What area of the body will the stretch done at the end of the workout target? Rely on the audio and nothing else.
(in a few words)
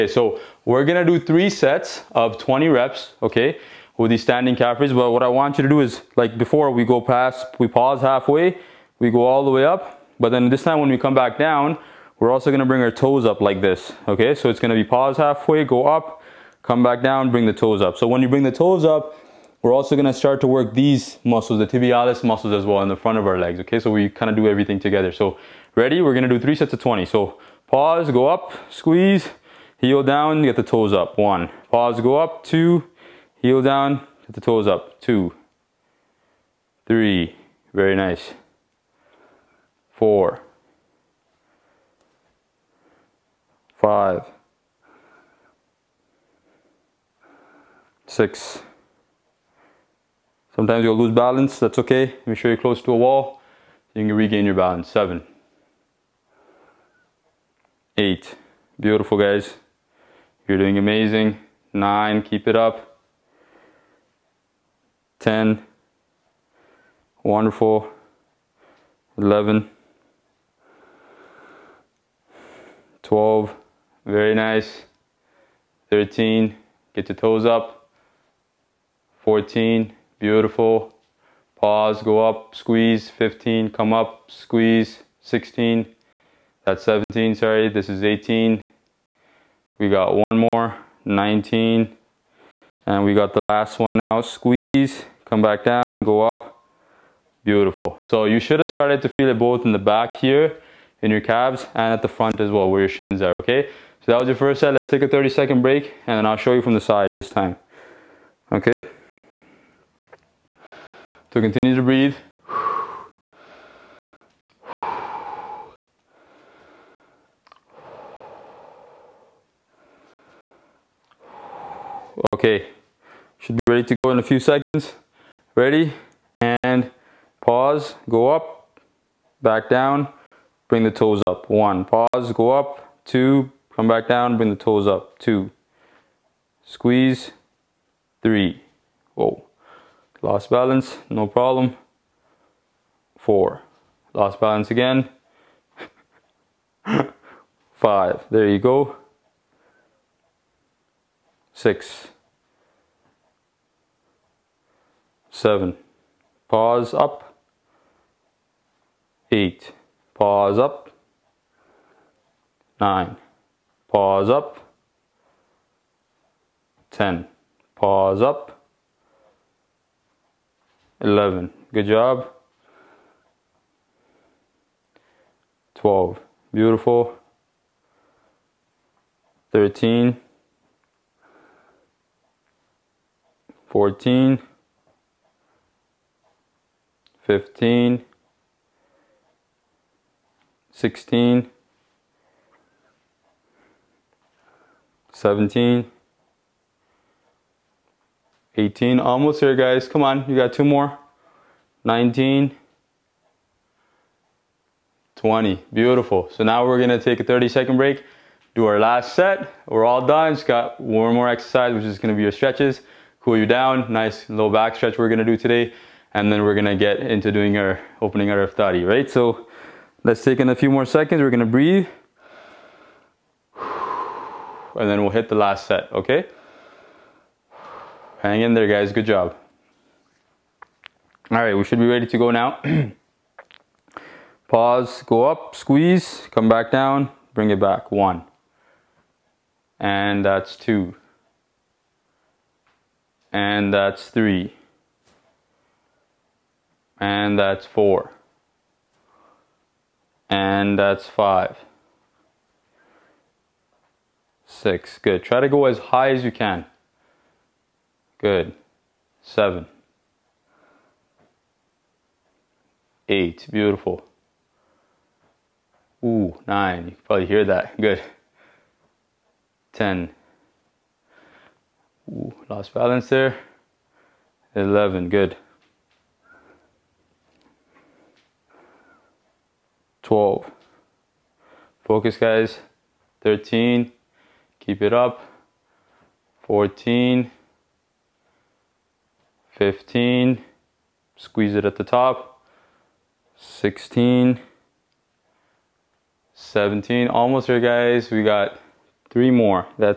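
low back.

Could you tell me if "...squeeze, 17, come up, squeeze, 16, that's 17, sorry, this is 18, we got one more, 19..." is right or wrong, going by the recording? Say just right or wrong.
wrong.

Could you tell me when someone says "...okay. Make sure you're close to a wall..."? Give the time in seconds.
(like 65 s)
51 s.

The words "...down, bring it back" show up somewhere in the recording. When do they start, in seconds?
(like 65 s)
236 s.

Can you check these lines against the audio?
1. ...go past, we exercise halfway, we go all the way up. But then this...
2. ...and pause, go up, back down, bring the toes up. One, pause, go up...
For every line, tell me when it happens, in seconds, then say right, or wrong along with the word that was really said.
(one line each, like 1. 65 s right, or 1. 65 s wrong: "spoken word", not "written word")
1. 6 s wrong: "pause", not "exercise"
2. 126 s right.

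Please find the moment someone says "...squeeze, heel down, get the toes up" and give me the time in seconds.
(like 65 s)
28 s.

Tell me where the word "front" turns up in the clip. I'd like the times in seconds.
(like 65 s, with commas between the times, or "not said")
22 s, 102 s.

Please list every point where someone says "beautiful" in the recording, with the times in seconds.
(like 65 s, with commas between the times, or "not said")
58 s, 80 s, 97 s, 176 s, 205 s, 263 s.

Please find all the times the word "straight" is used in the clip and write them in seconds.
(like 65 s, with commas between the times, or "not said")
not said.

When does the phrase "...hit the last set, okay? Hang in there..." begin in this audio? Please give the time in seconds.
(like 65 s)
225 s.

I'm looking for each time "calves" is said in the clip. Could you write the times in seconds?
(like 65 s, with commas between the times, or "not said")
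101 s.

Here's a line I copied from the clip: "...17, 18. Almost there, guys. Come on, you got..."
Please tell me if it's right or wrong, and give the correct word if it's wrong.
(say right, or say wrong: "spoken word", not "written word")
right.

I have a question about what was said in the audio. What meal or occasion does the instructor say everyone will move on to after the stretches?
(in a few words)
iftari.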